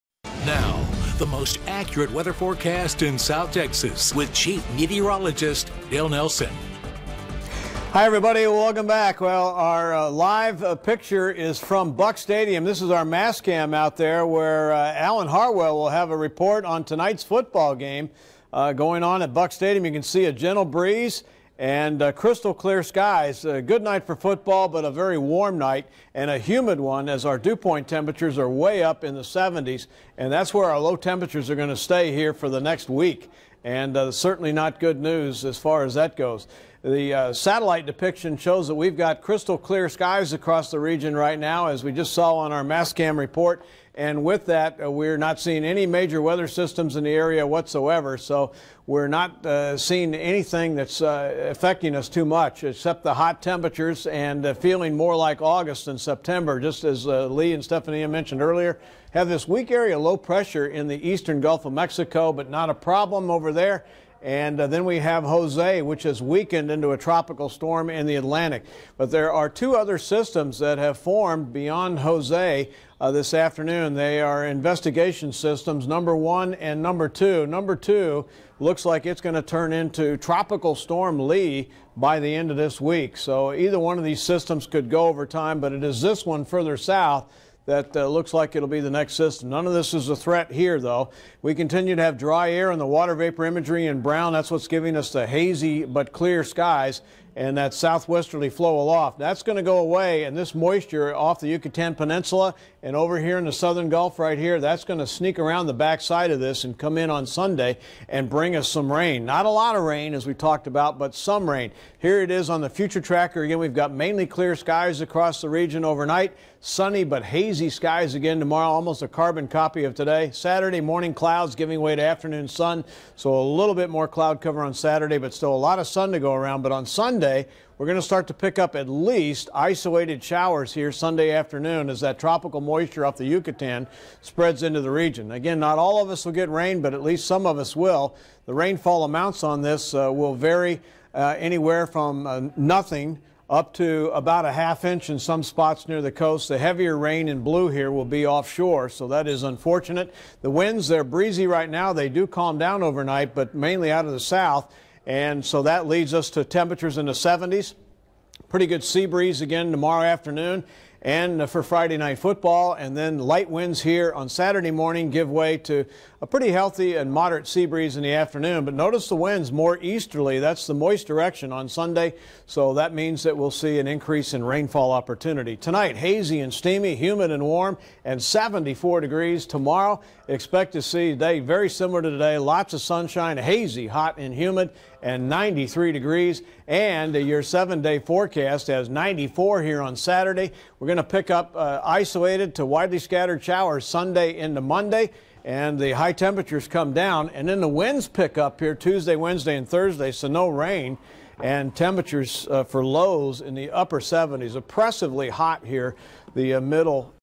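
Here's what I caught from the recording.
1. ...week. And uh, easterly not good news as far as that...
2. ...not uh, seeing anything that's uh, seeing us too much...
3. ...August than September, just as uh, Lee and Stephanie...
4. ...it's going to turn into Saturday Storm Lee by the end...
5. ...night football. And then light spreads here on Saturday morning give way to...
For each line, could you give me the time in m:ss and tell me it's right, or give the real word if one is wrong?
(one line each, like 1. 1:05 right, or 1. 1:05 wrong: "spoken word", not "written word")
1. 0:32 wrong: "certainly", not "easterly"
2. 0:49 wrong: "affecting", not "seeing"
3. 0:55 right
4. 1:19 wrong: "Tropical", not "Saturday"
5. 2:41 wrong: "winds", not "spreads".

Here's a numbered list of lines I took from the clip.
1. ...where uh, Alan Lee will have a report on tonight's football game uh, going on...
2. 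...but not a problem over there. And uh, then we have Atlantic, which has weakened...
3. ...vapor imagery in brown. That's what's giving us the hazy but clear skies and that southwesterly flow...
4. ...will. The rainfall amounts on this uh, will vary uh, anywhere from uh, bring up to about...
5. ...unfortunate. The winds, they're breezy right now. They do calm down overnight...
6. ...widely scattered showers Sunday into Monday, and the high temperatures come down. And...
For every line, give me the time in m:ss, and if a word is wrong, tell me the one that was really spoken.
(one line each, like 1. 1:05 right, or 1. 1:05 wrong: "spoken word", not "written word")
1. 0:14 wrong: "Harwell", not "Lee"
2. 1:02 wrong: "Jose", not "Atlantic"
3. 1:33 right
4. 2:17 wrong: "nothing", not "bring"
5. 2:29 right
6. 3:12 right.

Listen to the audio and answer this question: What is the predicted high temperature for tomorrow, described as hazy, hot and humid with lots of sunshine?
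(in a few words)
93 degrees.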